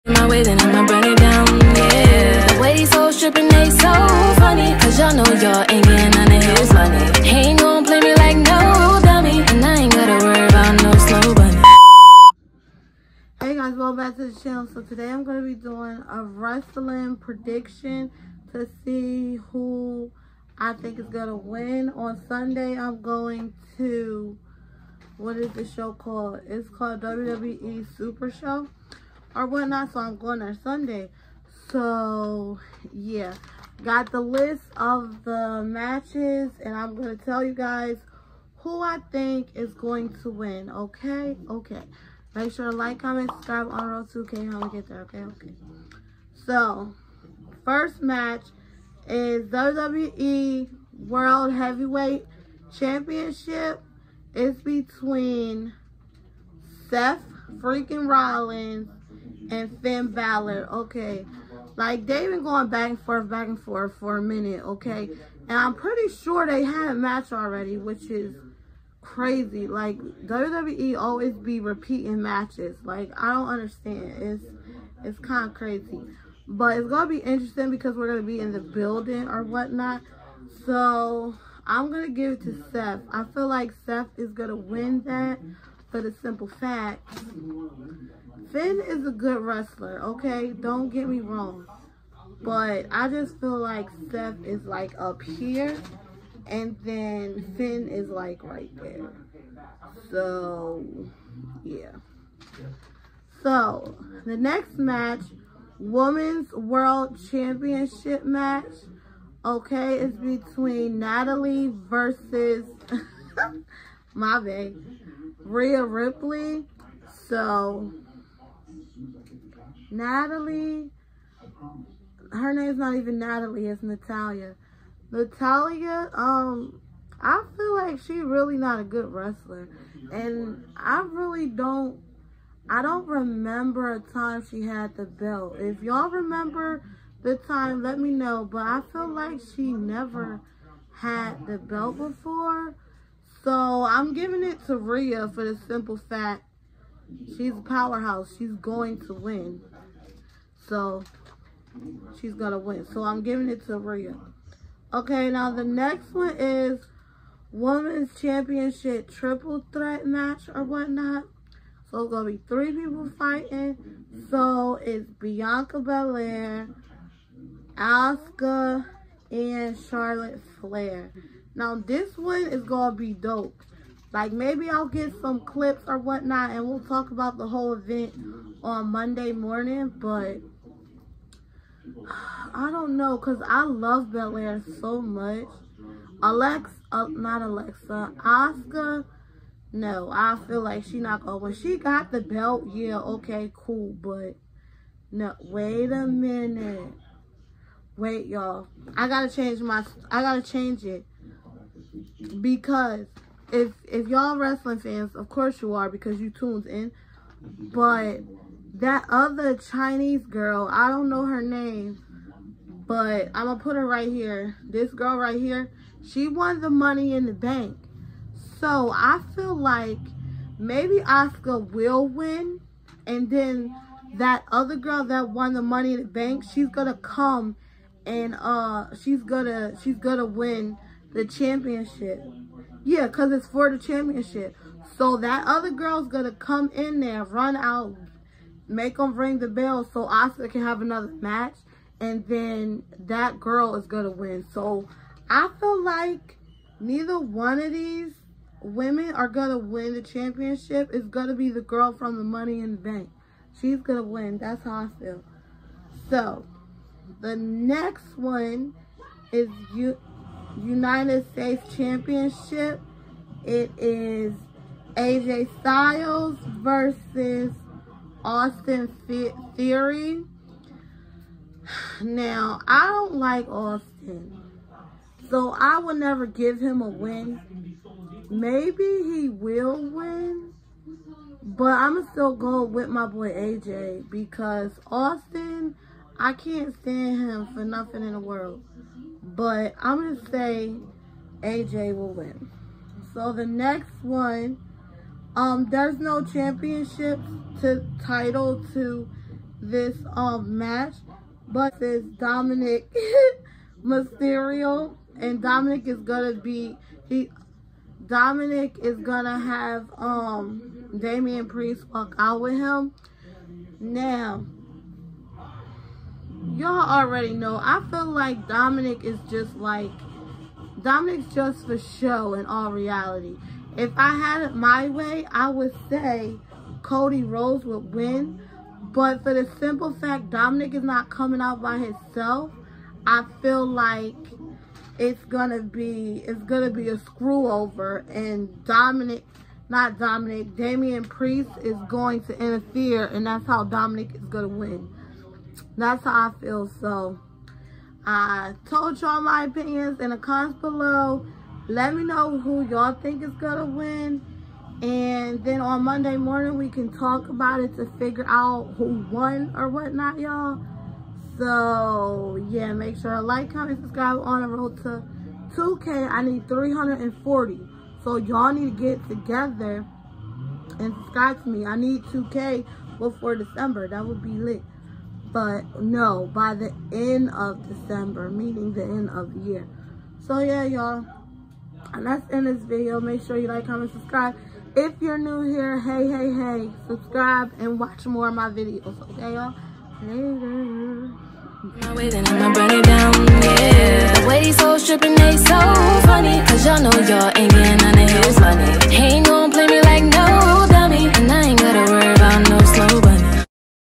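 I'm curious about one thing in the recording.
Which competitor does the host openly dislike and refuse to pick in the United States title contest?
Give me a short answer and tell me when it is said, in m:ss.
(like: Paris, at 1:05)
Austin Theory, at 4:28.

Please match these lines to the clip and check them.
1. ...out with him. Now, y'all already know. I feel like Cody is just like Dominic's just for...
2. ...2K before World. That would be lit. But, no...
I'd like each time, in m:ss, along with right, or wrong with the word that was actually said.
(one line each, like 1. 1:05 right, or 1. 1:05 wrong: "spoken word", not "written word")
1. 5:12 wrong: "Dominic", not "Cody"
2. 6:12 wrong: "December", not "World".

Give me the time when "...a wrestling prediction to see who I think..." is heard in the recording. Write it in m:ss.
0:16.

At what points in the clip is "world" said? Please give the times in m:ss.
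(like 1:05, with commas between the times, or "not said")
0:50, 1:46, 4:48.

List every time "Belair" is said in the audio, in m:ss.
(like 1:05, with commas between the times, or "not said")
2:45, 3:04.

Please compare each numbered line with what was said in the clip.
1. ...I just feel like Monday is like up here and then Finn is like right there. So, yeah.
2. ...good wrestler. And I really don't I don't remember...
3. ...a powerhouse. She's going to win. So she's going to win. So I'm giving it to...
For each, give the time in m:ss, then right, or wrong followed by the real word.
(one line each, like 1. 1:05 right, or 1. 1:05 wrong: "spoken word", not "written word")
1. 1:32 wrong: "Seth", not "Monday"
2. 2:08 right
3. 2:27 right.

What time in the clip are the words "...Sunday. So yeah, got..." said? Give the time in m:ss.
0:30.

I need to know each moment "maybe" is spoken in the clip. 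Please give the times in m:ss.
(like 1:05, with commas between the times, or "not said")
2:54, 3:40, 4:38.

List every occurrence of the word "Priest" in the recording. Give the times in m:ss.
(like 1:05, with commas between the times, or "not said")
5:11, 5:41.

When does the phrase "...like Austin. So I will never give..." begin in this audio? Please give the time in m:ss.
4:33.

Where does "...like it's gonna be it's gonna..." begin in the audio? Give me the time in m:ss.
5:33.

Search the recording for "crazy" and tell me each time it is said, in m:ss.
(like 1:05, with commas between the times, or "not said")
1:09, 1:15.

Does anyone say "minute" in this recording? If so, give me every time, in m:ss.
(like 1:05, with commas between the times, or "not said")
1:04, 3:16.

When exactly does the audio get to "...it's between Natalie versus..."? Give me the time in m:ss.
1:49.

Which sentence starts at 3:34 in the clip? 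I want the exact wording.
This girl right here, she won the money in the bank.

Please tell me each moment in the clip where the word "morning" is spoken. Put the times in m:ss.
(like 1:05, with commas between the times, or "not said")
2:59, 5:56.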